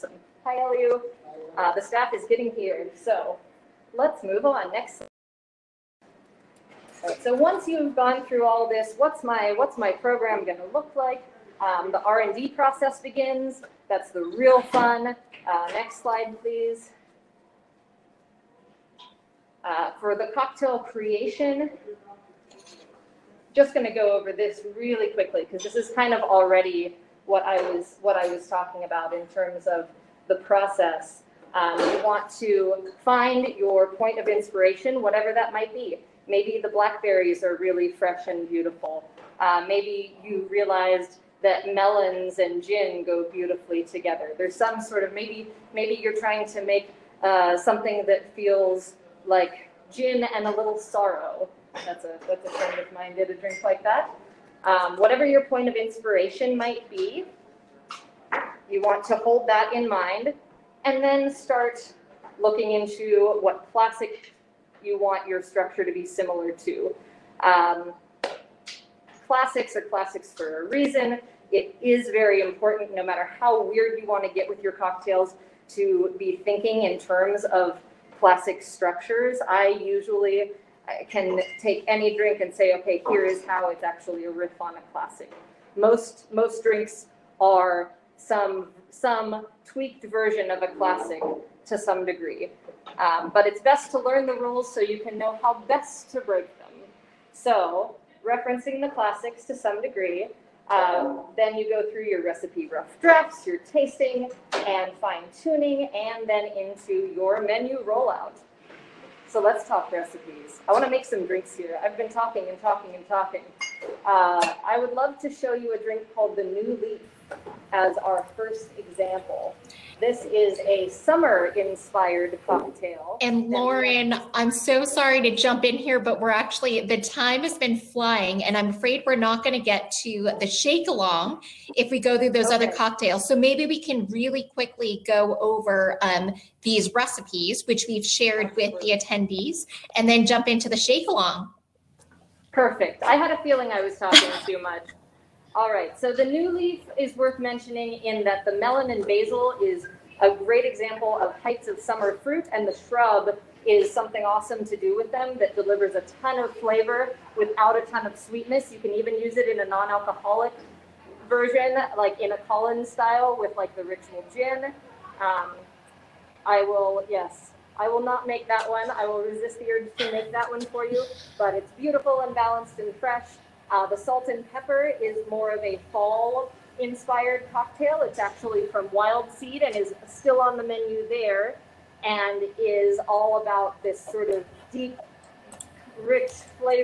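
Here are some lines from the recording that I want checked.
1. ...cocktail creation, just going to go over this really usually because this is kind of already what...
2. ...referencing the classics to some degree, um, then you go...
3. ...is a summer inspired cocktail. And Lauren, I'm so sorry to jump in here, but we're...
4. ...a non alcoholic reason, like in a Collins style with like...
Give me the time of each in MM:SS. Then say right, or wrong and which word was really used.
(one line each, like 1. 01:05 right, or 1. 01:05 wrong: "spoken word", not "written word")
1. 00:20 wrong: "quickly", not "usually"
2. 01:38 right
3. 02:00 right
4. 02:39 wrong: "version", not "reason".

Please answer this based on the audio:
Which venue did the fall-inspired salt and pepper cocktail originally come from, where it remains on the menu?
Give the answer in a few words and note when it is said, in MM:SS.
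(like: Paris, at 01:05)
Wildseed, at 02:58.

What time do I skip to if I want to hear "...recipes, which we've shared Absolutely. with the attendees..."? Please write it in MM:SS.
02:16.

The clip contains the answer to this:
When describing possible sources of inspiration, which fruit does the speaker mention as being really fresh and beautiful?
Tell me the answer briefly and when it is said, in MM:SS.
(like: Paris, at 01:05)
blackberries, at 00:36.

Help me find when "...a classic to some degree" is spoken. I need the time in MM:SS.
01:30.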